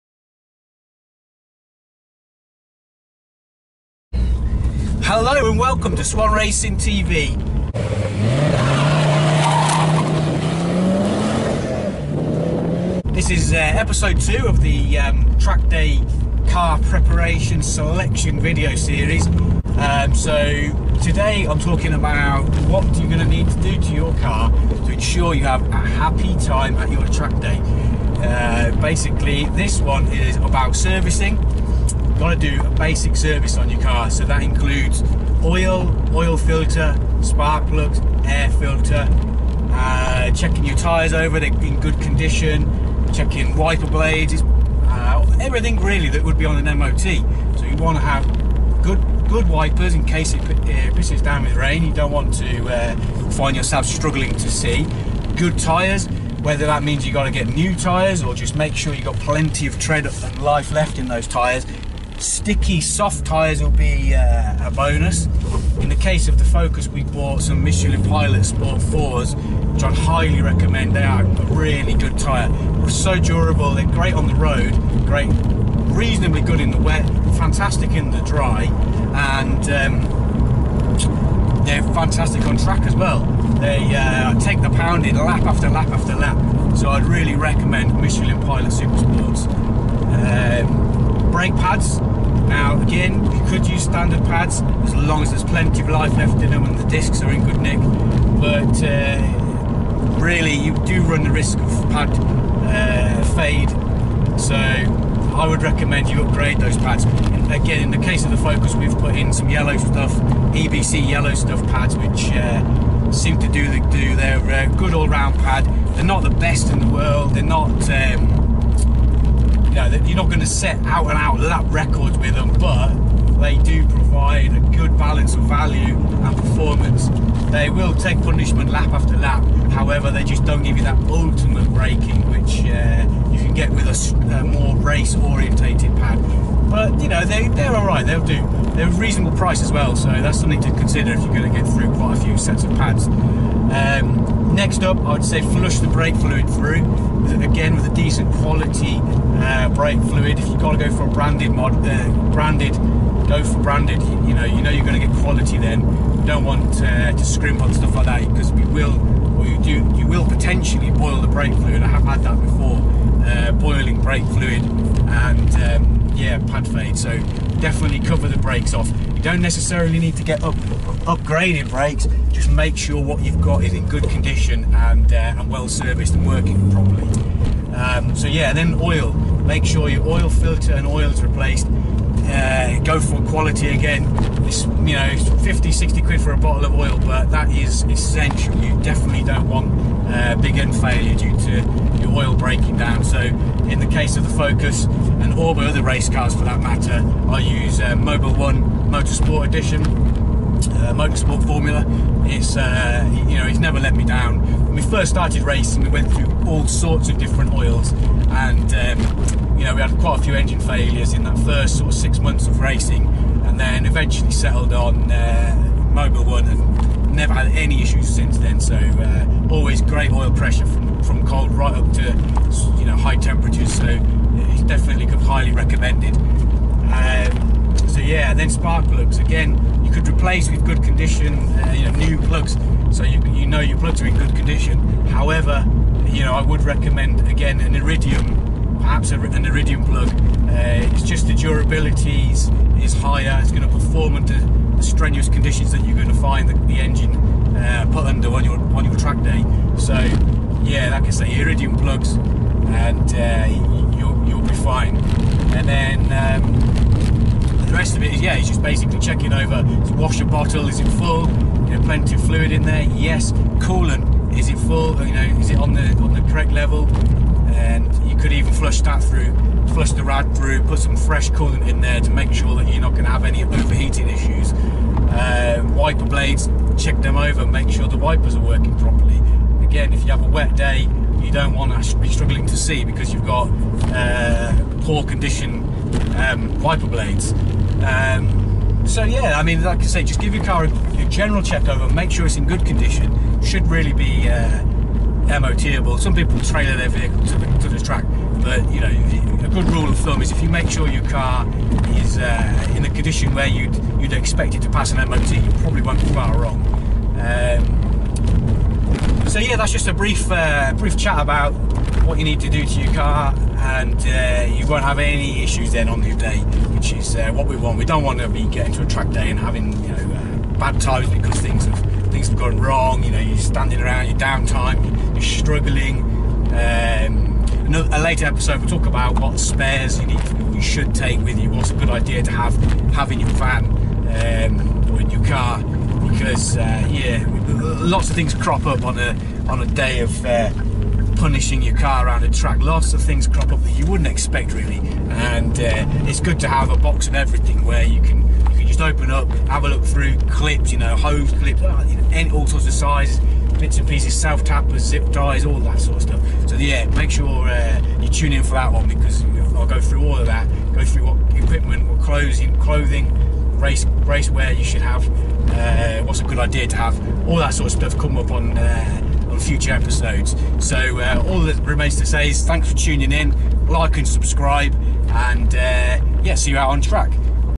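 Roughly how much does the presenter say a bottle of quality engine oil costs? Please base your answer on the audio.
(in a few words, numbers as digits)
50 to 60 pounds.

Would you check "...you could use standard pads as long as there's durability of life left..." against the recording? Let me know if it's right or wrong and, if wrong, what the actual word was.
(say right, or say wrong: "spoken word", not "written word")
wrong: "plenty", not "durability".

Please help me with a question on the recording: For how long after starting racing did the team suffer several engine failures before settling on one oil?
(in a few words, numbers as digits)
six months.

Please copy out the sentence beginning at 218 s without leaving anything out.
So uh, always great oil pressure from, from cold right up to you know high temperatures.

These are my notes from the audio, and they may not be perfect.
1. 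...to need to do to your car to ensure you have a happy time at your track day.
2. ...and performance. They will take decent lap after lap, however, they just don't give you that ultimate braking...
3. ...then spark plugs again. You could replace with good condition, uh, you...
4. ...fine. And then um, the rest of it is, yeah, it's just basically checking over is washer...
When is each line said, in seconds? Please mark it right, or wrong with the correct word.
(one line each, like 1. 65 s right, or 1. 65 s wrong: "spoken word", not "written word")
1. 23 s right
2. 125 s wrong: "punishment", not "decent"
3. 228 s right
4. 254 s right.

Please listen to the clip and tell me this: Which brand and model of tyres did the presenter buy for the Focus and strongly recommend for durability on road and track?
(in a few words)
Michelin Pilot Sport 4.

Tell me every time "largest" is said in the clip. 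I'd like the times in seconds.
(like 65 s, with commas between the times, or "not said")
not said.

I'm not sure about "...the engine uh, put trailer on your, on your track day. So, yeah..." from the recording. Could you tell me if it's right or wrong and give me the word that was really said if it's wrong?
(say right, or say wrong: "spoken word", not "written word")
wrong: "under", not "trailer".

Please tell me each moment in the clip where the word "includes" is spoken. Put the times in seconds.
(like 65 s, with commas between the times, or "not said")
34 s.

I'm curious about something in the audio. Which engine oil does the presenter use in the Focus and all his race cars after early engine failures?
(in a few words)
Mobil 1 Motorsport Edition.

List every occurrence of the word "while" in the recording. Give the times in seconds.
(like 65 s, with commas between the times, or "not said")
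not said.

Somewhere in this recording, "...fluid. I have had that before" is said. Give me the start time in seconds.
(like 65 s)
161 s.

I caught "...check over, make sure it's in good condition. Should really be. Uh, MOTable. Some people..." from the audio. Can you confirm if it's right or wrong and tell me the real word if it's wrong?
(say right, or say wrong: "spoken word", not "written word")
right.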